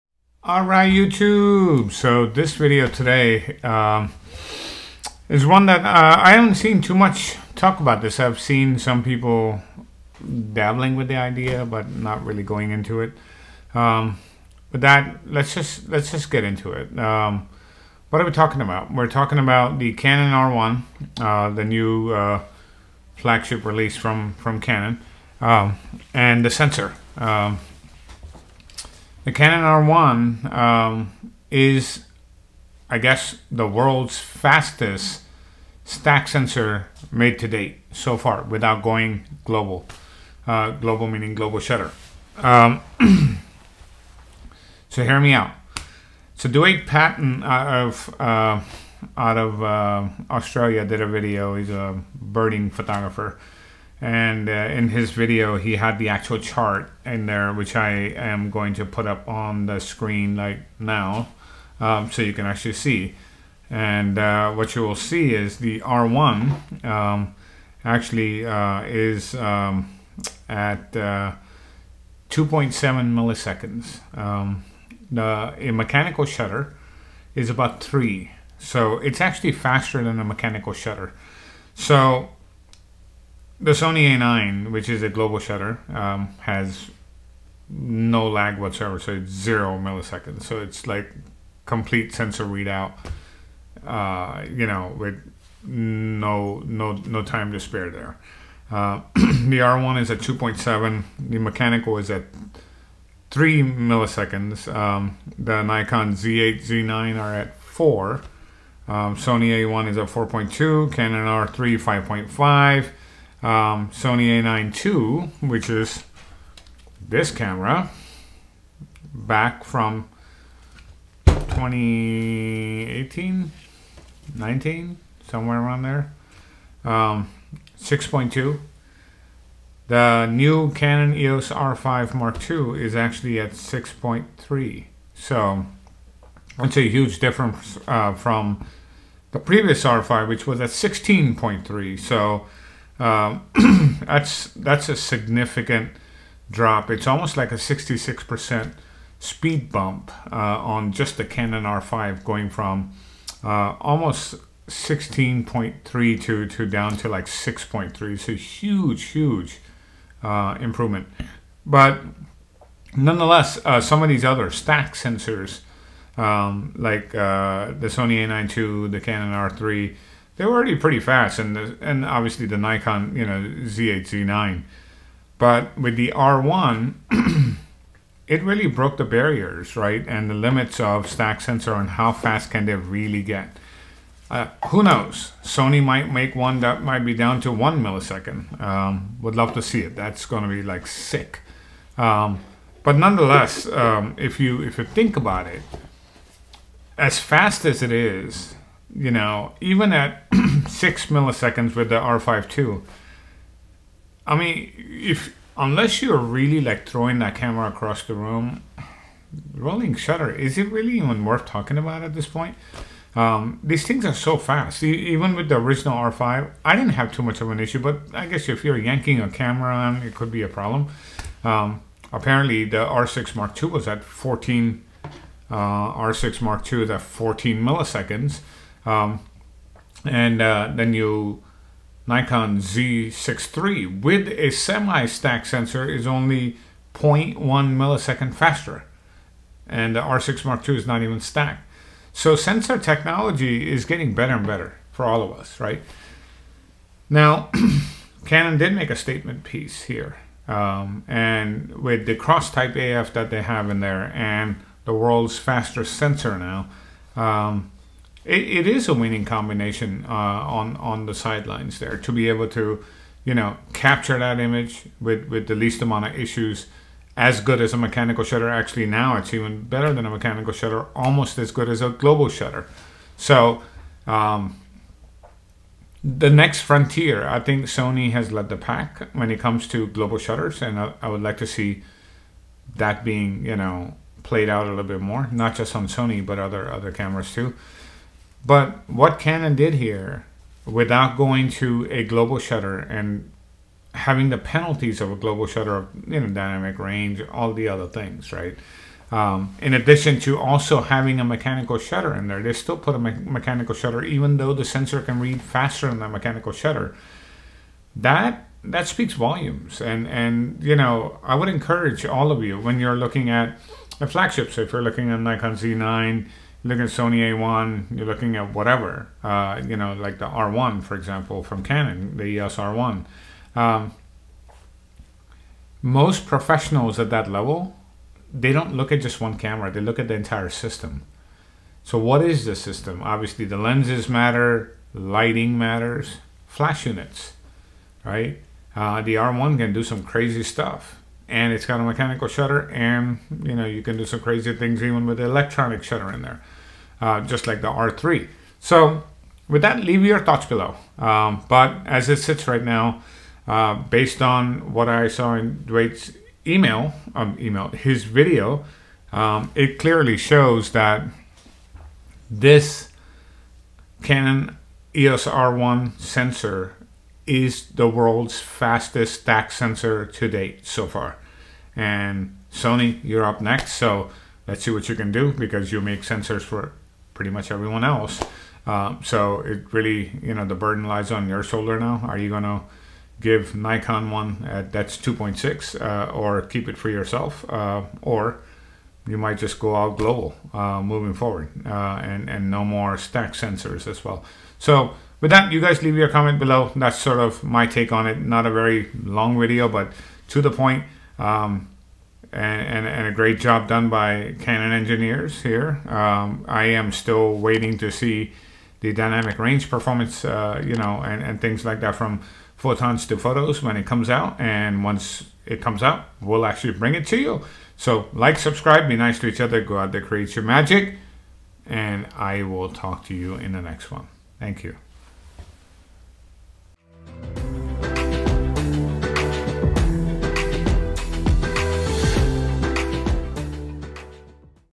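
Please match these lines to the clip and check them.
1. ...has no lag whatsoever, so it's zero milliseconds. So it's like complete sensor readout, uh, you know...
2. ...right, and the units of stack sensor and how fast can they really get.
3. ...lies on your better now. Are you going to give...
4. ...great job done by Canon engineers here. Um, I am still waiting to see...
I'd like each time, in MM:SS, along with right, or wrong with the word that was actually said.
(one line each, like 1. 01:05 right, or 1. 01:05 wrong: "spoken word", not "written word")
1. 01:26 right
2. 02:59 wrong: "limits", not "units"
3. 06:20 wrong: "shoulder", not "better"
4. 06:43 right.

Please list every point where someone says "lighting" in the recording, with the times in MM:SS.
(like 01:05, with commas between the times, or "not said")
05:34.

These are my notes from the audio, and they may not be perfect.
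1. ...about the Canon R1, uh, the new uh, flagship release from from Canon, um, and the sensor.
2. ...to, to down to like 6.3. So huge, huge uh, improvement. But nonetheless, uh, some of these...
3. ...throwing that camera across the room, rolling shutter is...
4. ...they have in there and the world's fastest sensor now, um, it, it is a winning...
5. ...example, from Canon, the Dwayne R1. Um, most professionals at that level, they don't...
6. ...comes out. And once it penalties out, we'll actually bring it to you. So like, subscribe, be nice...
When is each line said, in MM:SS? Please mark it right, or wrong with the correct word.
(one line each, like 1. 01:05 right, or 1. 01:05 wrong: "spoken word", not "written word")
1. 00:19 right
2. 02:36 right
3. 03:26 right
4. 04:13 right
5. 05:20 wrong: "EOS", not "Dwayne"
6. 06:53 wrong: "comes", not "penalties".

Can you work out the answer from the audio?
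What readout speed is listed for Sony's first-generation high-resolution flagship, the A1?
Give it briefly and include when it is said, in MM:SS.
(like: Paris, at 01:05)
4.2 milliseconds, at 01:50.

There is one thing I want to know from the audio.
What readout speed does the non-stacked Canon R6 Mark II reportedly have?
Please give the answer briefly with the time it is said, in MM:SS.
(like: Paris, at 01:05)
14 milliseconds, at 03:47.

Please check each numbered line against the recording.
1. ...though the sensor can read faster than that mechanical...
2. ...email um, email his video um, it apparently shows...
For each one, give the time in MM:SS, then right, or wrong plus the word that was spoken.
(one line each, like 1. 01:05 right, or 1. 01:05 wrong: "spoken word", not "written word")
1. 05:04 right
2. 05:56 wrong: "clearly", not "apparently".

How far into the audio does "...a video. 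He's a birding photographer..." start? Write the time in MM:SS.
00:50.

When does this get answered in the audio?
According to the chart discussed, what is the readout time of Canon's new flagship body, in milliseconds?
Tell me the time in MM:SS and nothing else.
01:12.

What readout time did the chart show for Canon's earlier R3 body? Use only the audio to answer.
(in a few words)
5.5 milliseconds.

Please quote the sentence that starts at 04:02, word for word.
So sensor technology is getting better and better for all of us, right?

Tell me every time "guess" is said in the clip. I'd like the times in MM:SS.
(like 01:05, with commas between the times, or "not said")
00:32, 03:38.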